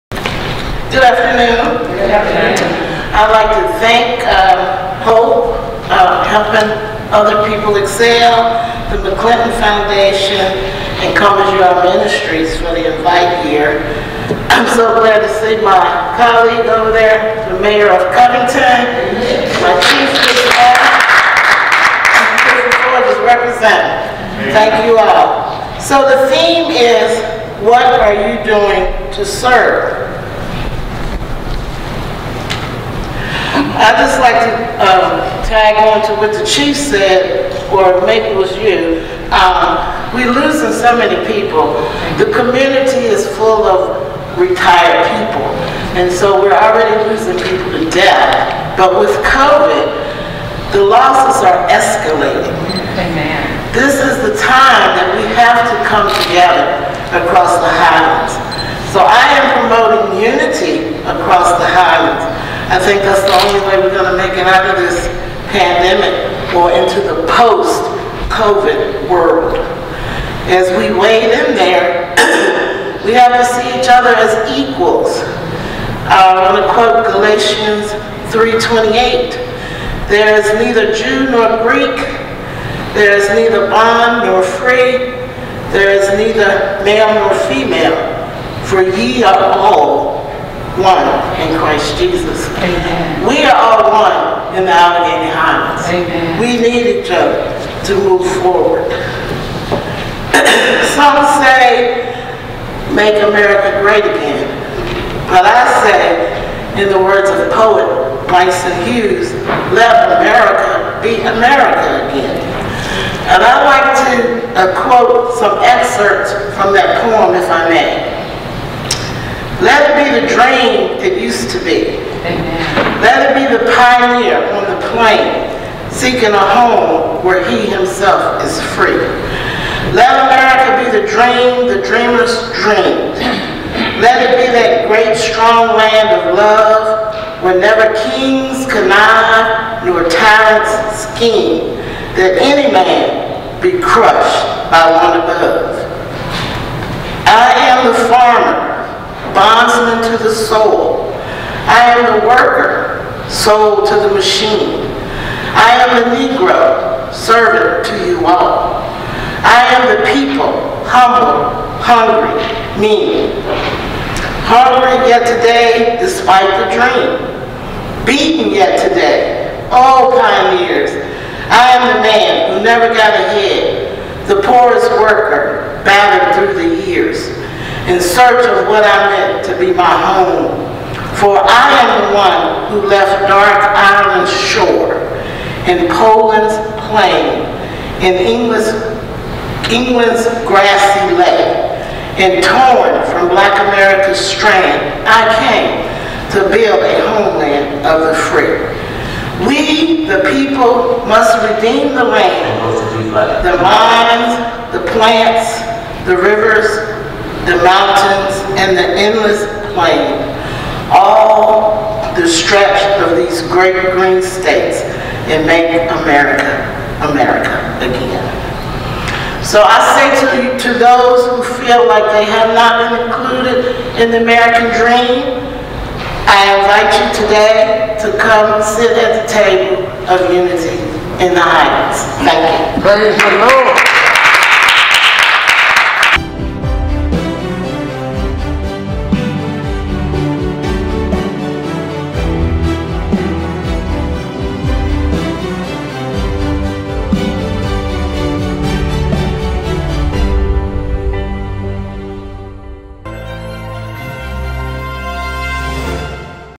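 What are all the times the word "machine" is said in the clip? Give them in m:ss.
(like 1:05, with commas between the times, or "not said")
2:34.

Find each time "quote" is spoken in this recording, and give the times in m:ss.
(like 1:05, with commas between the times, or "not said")
1:16, 1:54.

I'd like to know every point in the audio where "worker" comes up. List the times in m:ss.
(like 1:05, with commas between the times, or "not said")
2:32, 2:54.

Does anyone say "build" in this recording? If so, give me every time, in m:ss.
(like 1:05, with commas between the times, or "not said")
3:16.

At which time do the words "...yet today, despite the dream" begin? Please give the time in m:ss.
2:45.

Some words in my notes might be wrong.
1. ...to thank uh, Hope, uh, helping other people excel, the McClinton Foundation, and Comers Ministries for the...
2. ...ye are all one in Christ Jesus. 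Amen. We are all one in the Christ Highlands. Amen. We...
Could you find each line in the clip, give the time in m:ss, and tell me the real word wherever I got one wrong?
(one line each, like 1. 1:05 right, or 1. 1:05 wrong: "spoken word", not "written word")
1. 0:03 right
2. 1:28 wrong: "Alleghany", not "Christ".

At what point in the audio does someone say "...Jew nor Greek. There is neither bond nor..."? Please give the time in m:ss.
1:20.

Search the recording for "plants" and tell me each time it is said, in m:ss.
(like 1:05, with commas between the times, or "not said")
3:24.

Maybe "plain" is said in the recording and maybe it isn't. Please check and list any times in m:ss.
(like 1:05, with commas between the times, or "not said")
2:04, 3:06, 3:29.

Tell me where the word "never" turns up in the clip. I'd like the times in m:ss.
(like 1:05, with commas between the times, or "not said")
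2:17, 2:52.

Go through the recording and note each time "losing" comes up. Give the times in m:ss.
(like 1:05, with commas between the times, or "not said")
0:40, 0:47.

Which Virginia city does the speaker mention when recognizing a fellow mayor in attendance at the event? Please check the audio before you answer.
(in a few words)
Covington.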